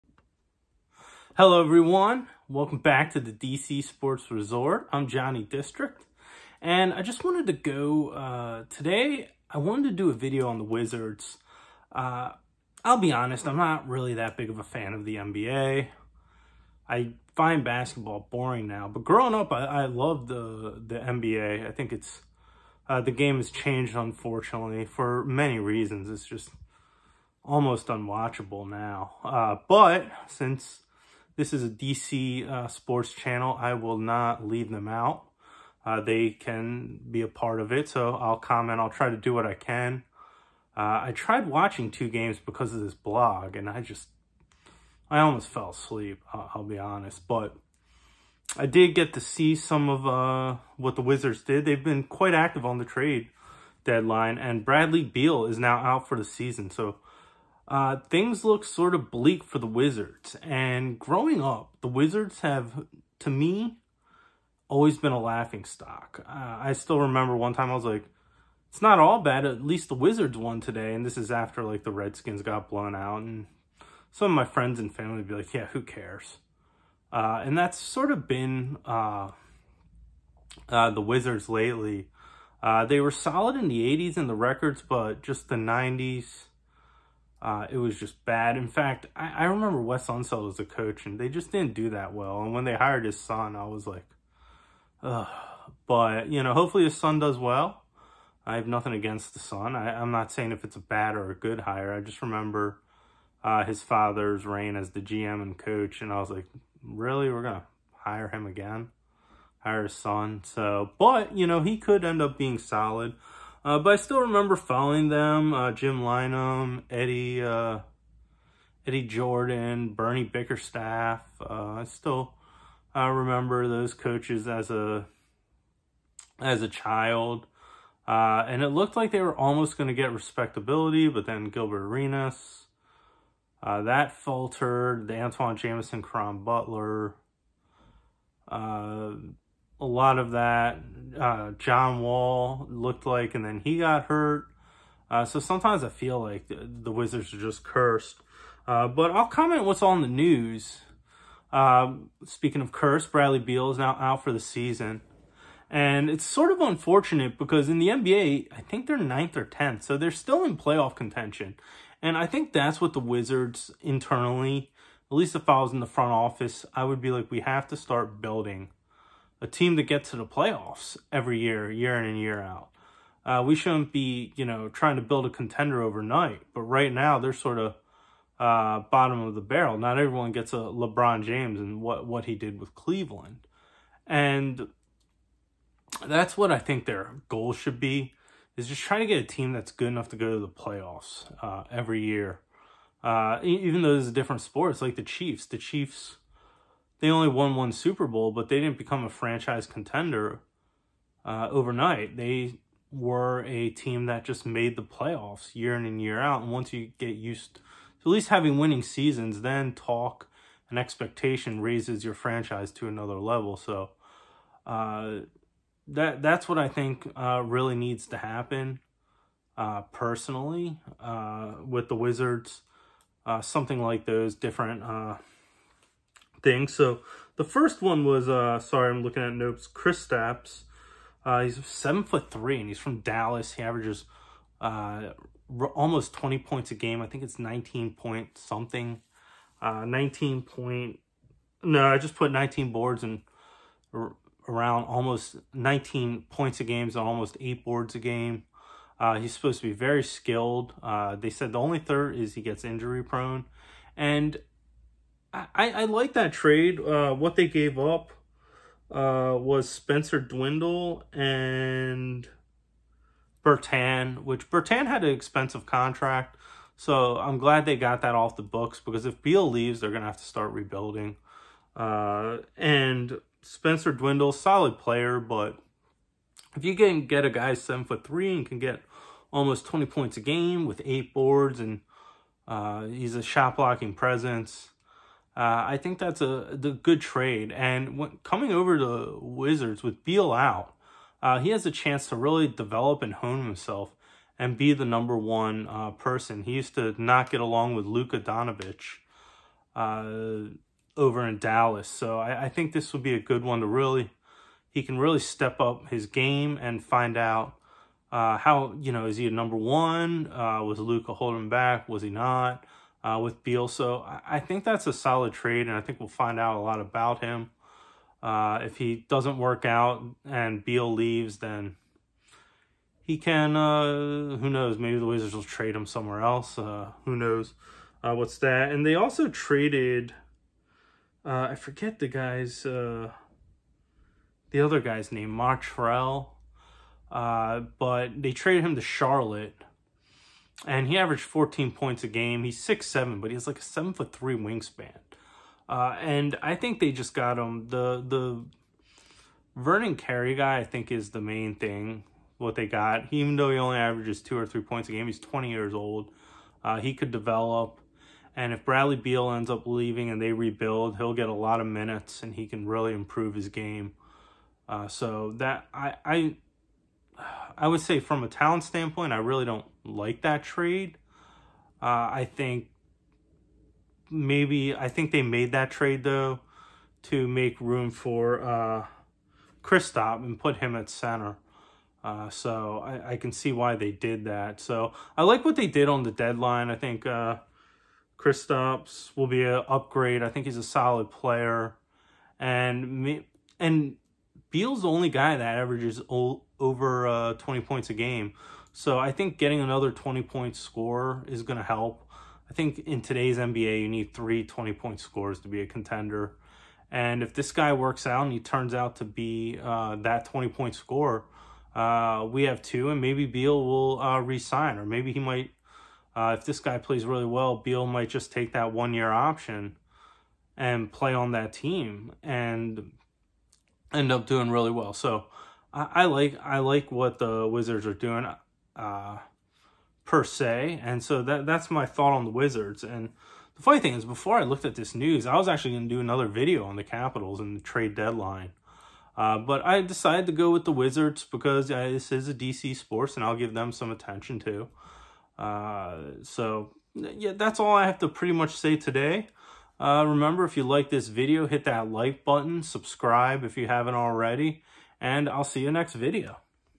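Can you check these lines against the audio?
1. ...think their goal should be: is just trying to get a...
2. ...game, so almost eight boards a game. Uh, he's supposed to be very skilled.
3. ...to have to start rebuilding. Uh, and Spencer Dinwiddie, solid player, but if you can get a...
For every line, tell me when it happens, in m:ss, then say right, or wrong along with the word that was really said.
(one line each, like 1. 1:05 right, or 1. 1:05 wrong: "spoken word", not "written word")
1. 3:06 right
2. 4:06 right
3. 4:30 right.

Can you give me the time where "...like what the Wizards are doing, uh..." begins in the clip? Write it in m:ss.
7:06.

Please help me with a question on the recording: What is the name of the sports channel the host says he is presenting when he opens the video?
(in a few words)
DC Sports Resort.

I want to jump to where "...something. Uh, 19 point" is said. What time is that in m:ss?
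3:58.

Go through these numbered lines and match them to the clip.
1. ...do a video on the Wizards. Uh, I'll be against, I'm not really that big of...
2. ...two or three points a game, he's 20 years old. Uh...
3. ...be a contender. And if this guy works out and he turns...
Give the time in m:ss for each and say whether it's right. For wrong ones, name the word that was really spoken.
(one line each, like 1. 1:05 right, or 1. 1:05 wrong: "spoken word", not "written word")
1. 0:09 wrong: "honest", not "against"
2. 5:54 right
3. 6:45 right.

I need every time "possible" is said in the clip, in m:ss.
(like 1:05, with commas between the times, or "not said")
not said.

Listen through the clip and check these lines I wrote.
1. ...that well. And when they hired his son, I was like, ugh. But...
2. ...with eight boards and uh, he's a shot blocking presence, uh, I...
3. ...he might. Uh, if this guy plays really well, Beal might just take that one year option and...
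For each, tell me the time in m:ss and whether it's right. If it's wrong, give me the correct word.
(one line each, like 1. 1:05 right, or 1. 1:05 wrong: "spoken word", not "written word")
1. 1:31 right
2. 4:40 right
3. 6:55 right.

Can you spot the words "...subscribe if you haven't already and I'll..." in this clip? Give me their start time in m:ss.
7:32.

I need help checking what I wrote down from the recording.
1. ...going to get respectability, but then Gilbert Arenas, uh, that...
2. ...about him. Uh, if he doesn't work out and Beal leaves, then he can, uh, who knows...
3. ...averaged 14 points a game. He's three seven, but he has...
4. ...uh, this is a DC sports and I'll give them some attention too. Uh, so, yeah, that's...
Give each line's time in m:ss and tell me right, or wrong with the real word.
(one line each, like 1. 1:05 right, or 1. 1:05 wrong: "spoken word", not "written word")
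1. 2:09 right
2. 5:16 right
3. 5:40 wrong: "six", not "three"
4. 7:21 right.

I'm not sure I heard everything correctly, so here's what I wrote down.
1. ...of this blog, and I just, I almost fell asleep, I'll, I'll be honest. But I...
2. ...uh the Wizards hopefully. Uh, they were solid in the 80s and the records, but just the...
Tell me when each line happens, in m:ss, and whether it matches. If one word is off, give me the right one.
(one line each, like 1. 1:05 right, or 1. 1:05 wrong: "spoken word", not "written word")
1. 0:42 right
2. 1:20 wrong: "lately", not "hopefully".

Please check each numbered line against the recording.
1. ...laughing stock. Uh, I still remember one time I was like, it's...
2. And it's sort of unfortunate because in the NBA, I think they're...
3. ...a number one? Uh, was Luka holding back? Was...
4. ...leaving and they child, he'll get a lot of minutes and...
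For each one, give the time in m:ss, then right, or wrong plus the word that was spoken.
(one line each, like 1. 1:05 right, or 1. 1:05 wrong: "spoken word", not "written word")
1. 1:05 right
2. 2:35 right
3. 5:09 right
4. 5:59 wrong: "rebuild", not "child".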